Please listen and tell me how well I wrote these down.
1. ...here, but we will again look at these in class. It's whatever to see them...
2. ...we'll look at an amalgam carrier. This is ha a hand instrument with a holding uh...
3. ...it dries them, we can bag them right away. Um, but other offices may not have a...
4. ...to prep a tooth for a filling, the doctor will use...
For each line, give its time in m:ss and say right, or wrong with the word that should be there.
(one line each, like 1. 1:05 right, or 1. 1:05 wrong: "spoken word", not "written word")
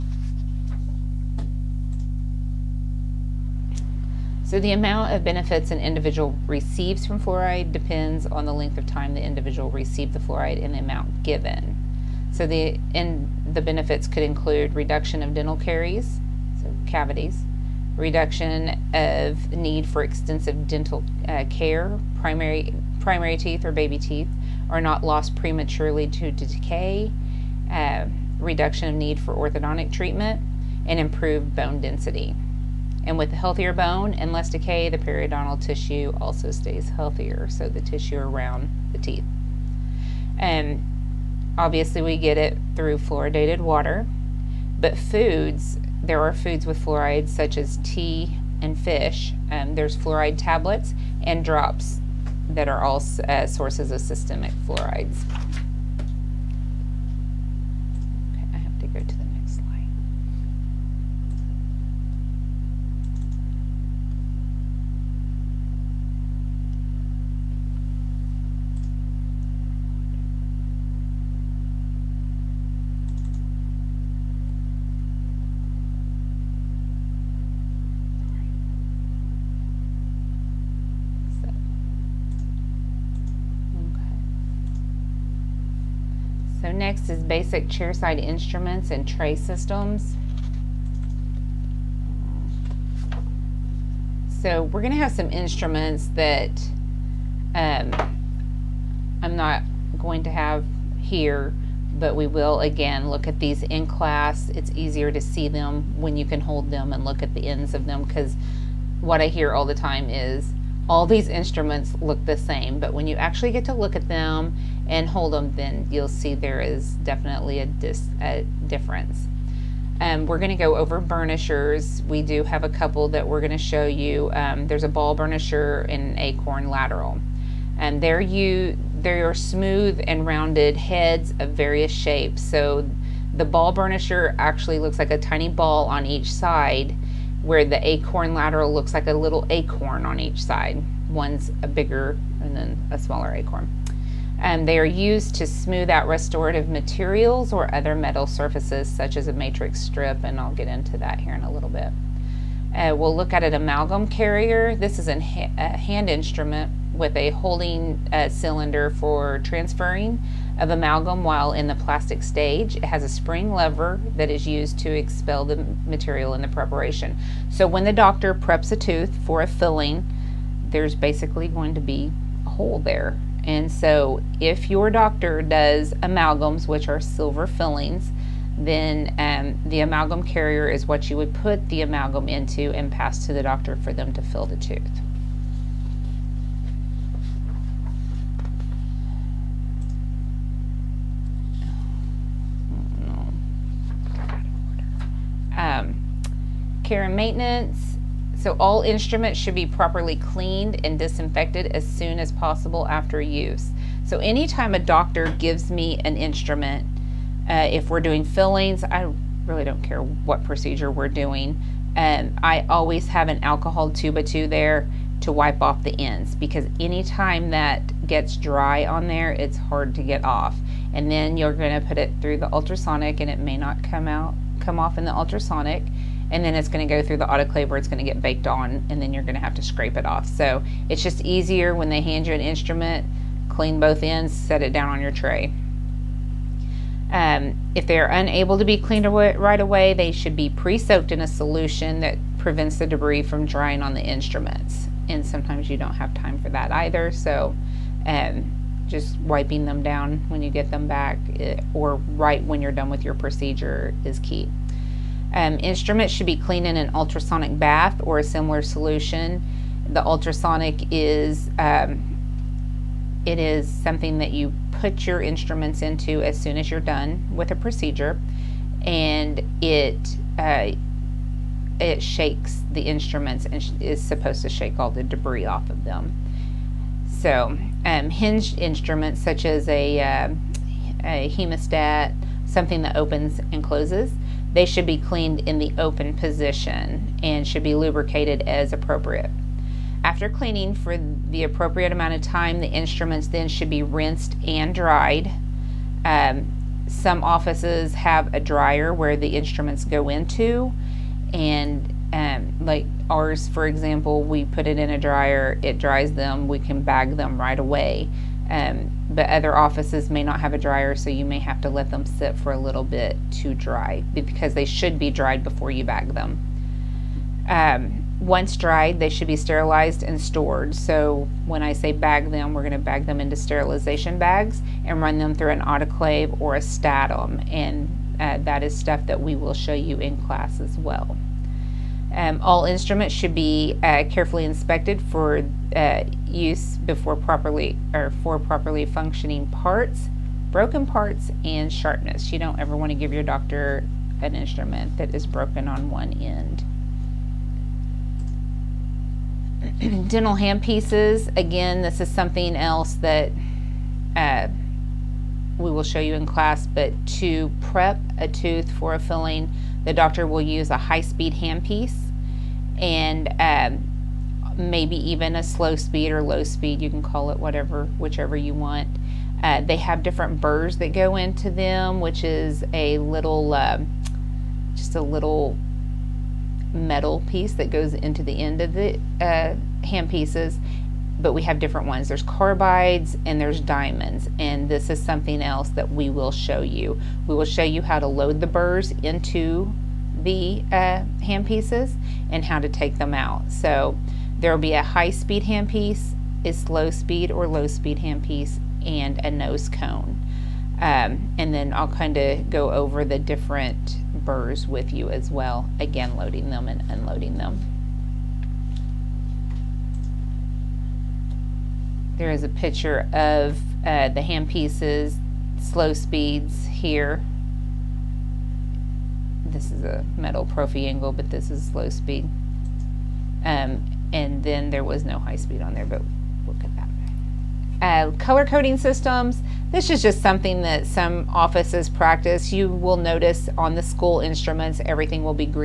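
1. 1:40 wrong: "easier", not "whatever"
2. 2:32 right
3. 5:05 right
4. 5:57 right.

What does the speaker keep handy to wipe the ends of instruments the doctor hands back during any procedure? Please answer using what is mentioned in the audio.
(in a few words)
alcohol.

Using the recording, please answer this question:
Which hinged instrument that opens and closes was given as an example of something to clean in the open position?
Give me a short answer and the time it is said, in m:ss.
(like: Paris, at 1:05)
hemostat, at 4:41.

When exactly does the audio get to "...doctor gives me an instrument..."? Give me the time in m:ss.
3:24.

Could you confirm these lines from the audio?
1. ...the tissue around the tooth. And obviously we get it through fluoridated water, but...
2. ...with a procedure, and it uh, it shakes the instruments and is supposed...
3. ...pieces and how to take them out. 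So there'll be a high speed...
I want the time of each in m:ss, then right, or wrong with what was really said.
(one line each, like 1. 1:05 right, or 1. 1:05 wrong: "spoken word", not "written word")
1. 0:37 wrong: "teeth", not "tooth"
2. 4:27 right
3. 6:31 right.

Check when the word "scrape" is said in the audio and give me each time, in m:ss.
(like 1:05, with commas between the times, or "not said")
3:49.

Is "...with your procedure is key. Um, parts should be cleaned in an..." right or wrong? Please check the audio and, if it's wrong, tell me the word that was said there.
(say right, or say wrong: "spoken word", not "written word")
wrong: "instruments", not "parts".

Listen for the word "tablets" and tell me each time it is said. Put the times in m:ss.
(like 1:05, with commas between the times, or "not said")
0:50.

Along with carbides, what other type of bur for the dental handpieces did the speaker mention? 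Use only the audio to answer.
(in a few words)
diamonds.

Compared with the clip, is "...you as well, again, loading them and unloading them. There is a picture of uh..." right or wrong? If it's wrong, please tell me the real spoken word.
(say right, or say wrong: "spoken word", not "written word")
right.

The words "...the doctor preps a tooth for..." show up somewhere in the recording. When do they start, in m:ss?
2:47.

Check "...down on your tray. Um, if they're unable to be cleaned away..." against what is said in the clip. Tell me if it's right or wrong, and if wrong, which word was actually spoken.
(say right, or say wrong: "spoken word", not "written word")
right.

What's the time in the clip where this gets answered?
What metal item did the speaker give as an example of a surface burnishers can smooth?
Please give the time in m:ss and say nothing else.
2:29.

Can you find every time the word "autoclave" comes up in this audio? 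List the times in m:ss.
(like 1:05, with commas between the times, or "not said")
3:47, 5:25.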